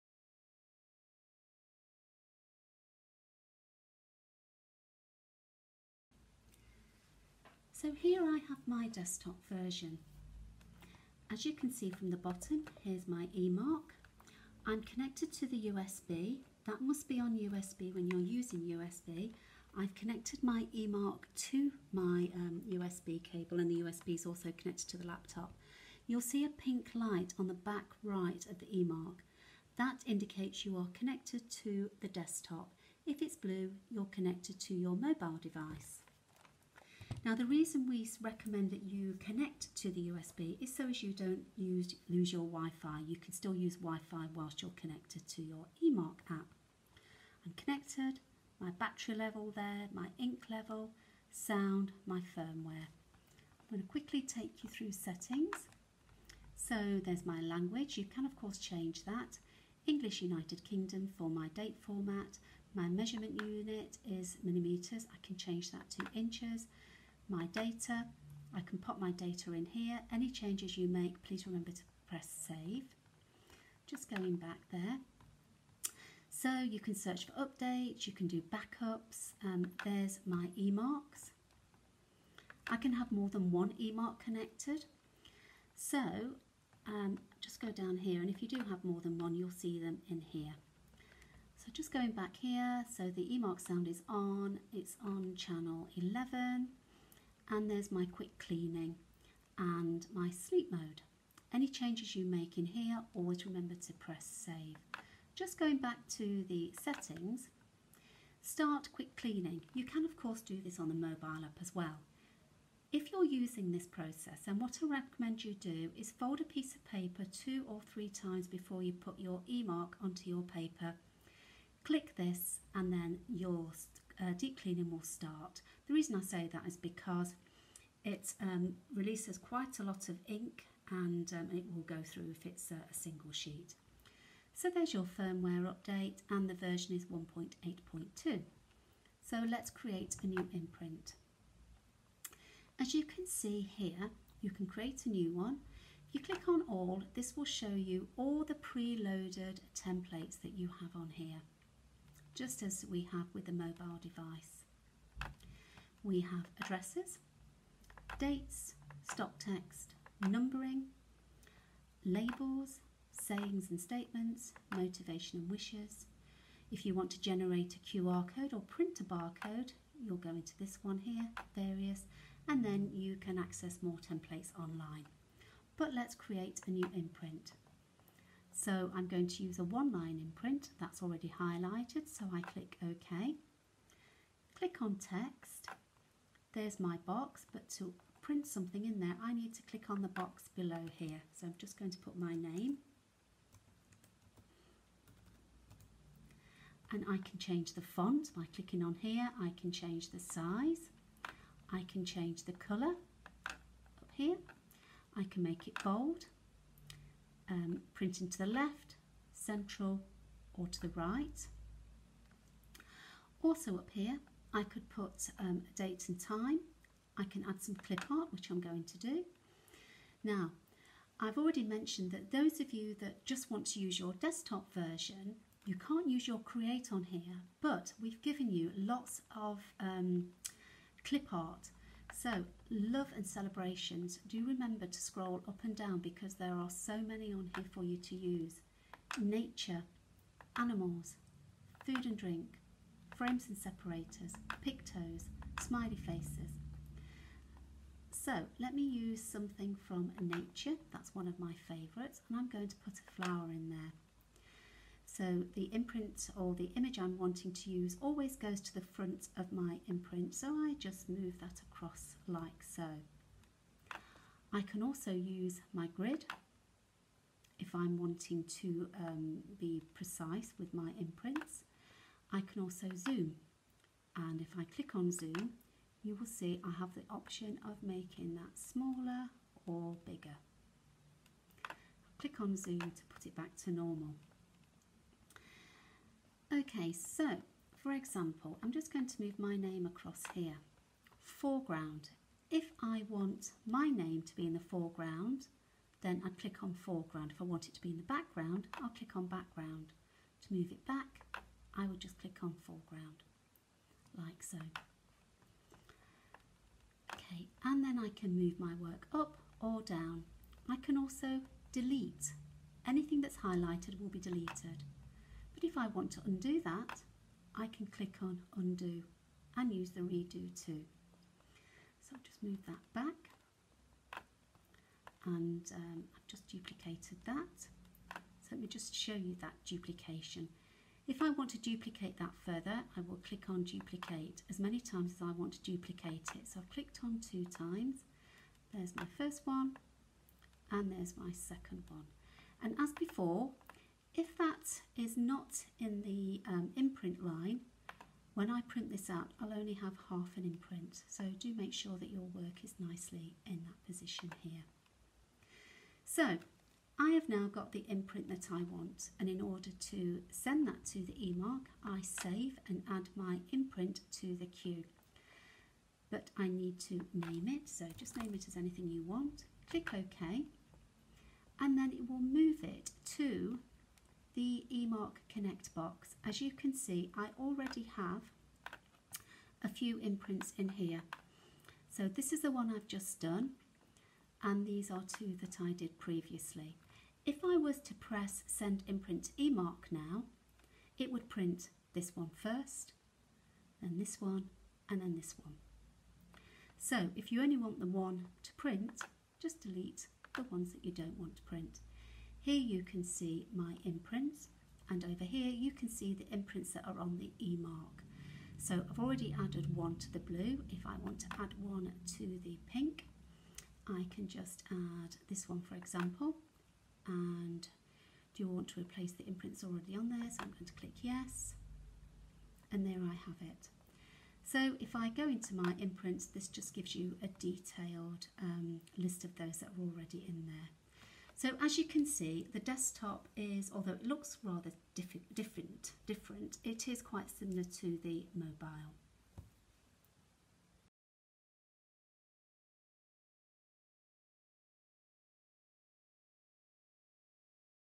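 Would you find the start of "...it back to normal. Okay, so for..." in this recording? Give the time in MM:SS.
04:43.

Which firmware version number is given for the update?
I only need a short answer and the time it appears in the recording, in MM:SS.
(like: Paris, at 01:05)
1.8.2, at 02:17.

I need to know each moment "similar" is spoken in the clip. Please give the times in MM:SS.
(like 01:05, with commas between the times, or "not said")
07:17.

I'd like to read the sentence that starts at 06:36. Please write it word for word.
So if you only want the one to print, just delete the ones that you don't want to print.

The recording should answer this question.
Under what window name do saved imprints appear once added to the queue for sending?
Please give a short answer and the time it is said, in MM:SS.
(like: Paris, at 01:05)
eMark Connect, at 06:14.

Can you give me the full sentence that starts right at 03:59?
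Nature, animals, food and drink, frames and separators, pictos, smiley faces.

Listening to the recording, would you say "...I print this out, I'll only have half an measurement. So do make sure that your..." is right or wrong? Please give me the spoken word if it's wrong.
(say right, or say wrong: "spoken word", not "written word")
wrong: "imprint", not "measurement".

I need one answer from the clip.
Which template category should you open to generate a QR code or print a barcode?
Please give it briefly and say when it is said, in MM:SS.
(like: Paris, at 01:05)
various, at 02:51.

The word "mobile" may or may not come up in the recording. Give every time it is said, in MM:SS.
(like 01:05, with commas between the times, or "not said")
00:34, 01:50, 02:33, 07:18.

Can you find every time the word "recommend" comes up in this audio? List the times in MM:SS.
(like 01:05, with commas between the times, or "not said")
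00:38, 01:54.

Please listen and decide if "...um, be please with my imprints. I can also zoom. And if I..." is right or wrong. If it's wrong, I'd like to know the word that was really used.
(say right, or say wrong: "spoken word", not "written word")
wrong: "precise", not "please".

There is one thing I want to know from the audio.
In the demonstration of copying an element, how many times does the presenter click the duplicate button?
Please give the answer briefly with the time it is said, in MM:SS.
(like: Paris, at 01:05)
2, at 05:37.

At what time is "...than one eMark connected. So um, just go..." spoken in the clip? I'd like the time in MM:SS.
01:23.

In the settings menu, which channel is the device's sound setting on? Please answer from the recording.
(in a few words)
11.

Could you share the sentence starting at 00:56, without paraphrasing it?
So there's my language, you can of course change that.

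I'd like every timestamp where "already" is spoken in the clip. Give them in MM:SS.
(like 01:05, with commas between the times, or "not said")
03:01, 03:41, 06:17, 06:48, 06:59, 07:09.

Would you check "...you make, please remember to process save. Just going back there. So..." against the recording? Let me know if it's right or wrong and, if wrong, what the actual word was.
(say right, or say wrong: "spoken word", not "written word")
wrong: "press", not "process".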